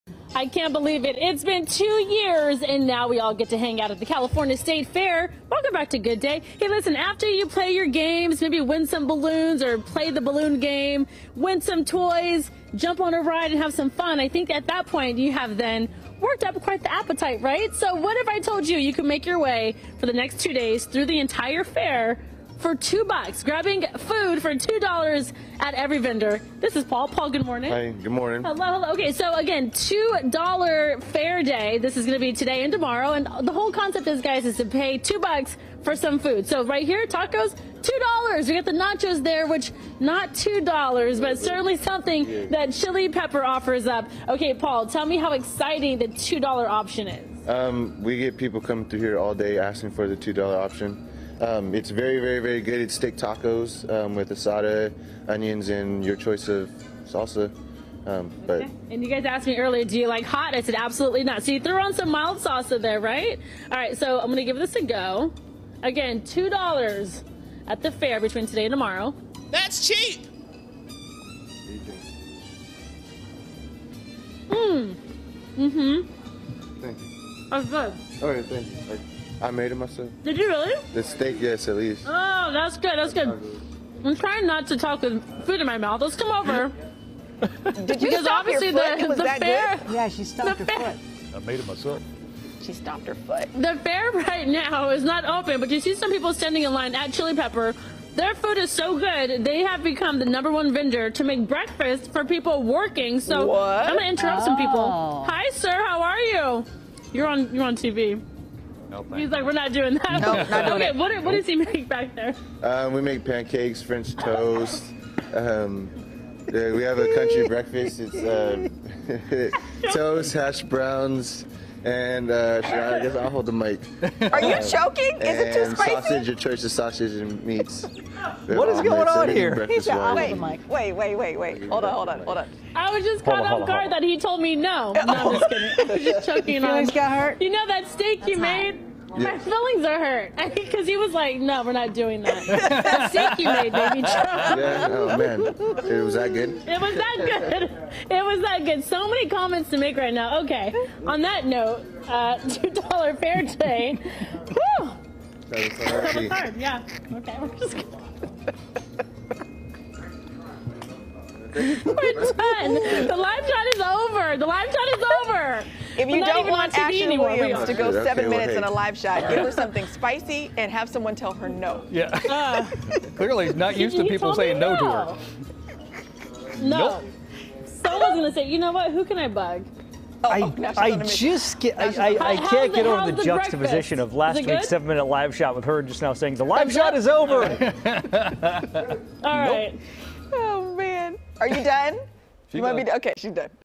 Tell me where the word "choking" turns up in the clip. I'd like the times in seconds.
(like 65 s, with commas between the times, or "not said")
124 s, 136 s.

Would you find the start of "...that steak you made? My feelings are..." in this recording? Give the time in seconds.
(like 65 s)
137 s.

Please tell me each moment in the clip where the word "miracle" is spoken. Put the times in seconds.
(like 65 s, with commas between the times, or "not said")
not said.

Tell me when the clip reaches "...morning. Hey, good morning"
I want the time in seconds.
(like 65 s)
27 s.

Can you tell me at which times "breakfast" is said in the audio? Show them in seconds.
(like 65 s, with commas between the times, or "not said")
101 s, 117 s, 183 s.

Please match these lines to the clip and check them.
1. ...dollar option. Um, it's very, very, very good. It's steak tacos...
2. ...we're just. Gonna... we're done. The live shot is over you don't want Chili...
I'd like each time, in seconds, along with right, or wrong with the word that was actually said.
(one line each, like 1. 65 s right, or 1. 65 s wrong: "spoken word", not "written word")
1. 50 s right
2. 157 s wrong: "Ashley", not "Chili".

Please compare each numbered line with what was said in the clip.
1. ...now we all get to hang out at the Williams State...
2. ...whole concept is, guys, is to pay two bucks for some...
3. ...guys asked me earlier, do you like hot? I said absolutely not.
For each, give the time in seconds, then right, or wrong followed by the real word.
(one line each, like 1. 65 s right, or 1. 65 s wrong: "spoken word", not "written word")
1. 2 s wrong: "California", not "Williams"
2. 33 s right
3. 59 s right.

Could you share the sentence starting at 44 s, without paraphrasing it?
Okay, Paul, tell me how exciting the two dollar option is.